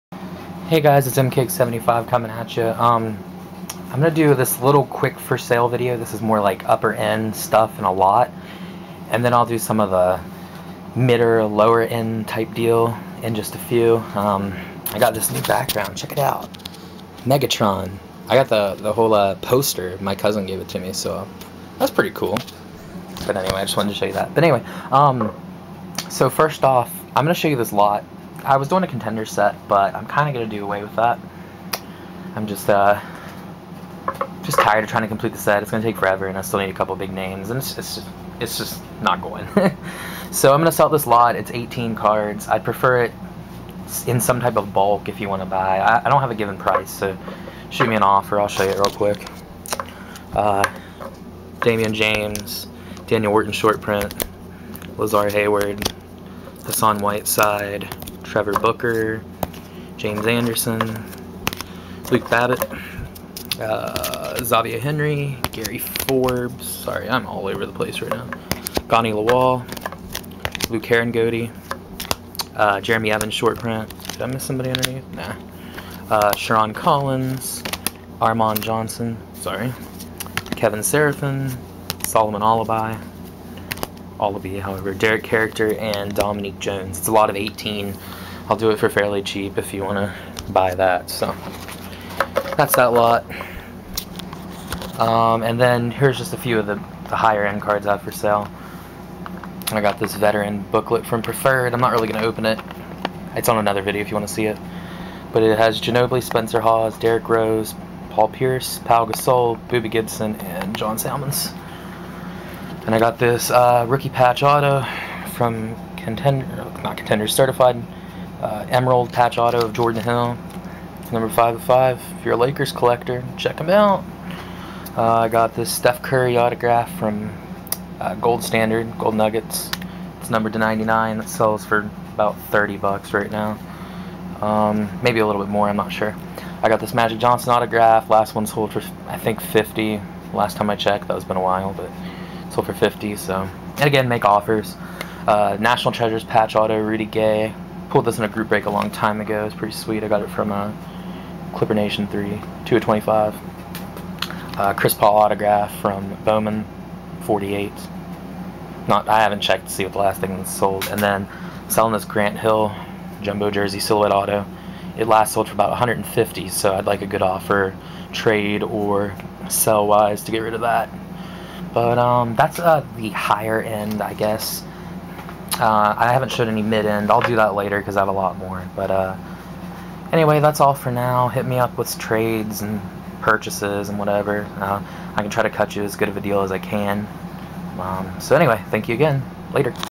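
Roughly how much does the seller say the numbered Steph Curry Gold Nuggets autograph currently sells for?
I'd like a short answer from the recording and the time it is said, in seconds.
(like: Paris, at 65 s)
30 bucks, at 132 s.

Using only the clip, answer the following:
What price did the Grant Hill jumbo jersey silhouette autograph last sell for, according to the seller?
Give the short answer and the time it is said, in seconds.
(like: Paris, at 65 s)
150, at 165 s.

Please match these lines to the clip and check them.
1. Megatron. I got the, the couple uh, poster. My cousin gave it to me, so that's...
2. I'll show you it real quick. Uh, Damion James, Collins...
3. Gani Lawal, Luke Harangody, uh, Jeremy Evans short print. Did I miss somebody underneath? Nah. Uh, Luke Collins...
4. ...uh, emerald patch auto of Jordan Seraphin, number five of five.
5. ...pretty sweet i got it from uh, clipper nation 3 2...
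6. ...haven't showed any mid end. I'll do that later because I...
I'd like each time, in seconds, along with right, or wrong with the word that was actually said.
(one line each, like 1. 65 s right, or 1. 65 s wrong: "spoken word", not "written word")
1. 17 s wrong: "whole", not "couple"
2. 48 s wrong: "Daniel", not "Collins"
3. 68 s wrong: "Sherron", not "Luke"
4. 118 s wrong: "Hill", not "Seraphin"
5. 149 s right
6. 176 s right.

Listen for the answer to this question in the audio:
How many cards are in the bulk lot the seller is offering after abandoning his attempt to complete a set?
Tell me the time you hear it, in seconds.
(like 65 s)
41 s.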